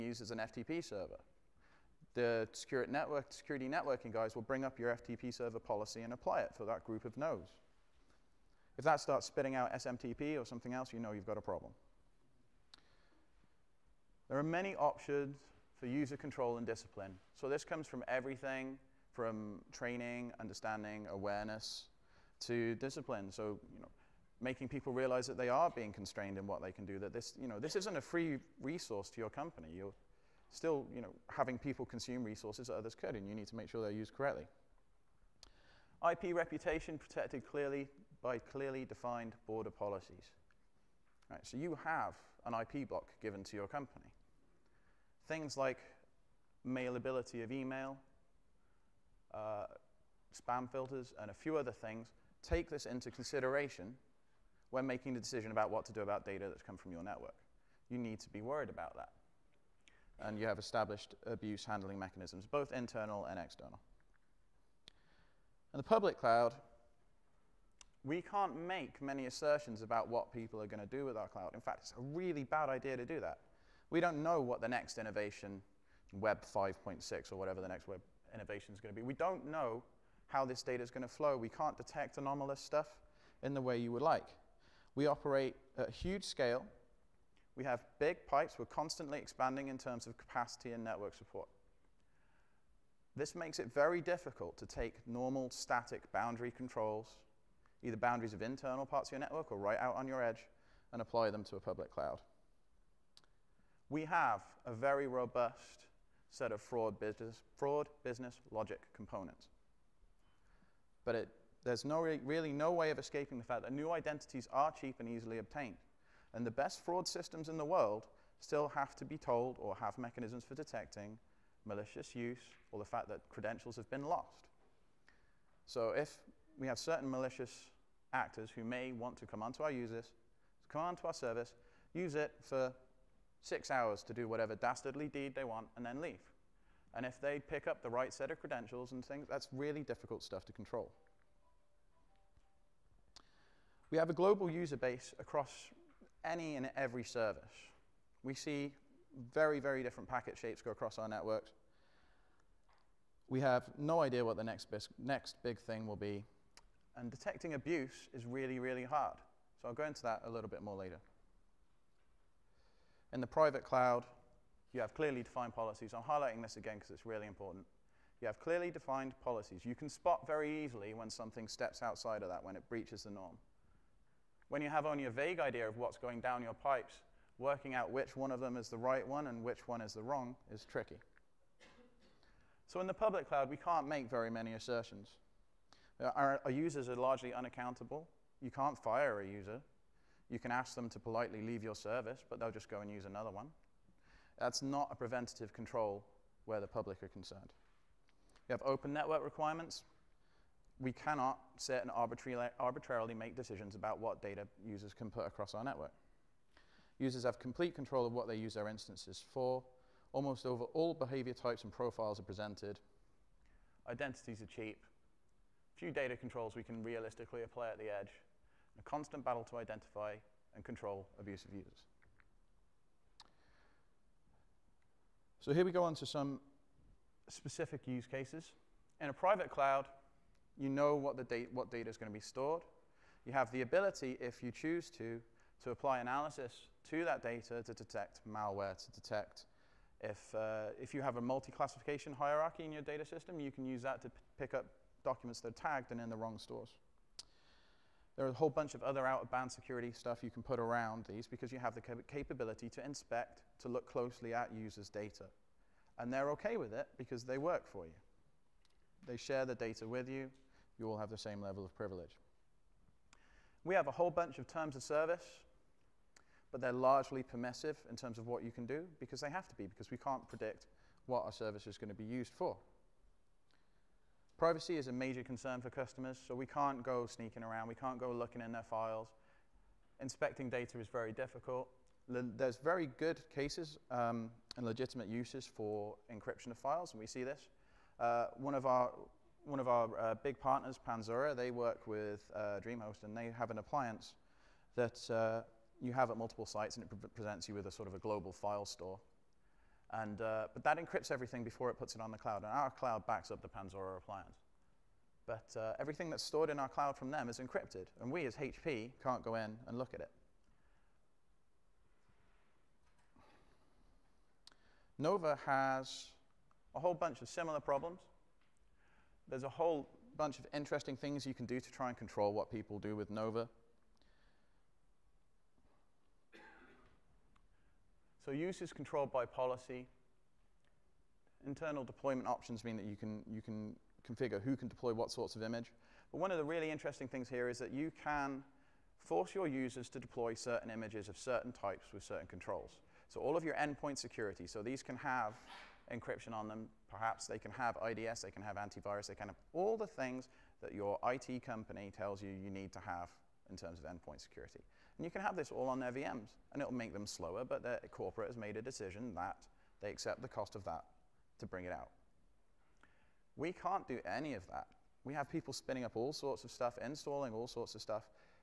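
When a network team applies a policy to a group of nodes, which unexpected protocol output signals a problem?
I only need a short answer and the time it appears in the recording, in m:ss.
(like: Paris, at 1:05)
SMTP, at 0:09.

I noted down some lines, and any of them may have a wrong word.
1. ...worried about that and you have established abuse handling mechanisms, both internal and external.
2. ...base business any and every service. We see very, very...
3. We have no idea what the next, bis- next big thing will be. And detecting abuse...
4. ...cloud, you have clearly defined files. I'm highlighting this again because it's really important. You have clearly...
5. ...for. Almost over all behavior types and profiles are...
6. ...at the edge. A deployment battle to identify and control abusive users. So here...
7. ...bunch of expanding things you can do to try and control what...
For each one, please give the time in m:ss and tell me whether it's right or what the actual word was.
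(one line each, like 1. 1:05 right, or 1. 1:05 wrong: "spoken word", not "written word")
1. 0:58 right
2. 2:24 wrong: "across", not "business"
3. 2:33 right
4. 2:43 wrong: "policies", not "files"
5. 3:29 right
6. 3:37 wrong: "constant", not "deployment"
7. 5:20 wrong: "interesting", not "expanding".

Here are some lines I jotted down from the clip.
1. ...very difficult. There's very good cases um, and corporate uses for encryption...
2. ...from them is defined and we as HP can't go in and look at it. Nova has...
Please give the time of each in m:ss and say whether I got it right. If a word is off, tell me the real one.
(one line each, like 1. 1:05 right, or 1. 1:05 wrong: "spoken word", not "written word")
1. 4:40 wrong: "legitimate", not "corporate"
2. 5:06 wrong: "encrypted", not "defined".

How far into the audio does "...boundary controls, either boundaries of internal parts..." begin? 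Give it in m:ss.
1:36.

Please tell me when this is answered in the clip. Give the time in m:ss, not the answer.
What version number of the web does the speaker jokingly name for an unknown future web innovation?
1:16.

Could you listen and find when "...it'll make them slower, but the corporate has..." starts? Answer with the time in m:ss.
5:56.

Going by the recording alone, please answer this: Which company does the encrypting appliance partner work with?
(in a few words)
DreamHost.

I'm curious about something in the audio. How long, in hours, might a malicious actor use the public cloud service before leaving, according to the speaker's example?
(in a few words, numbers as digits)
6 hours.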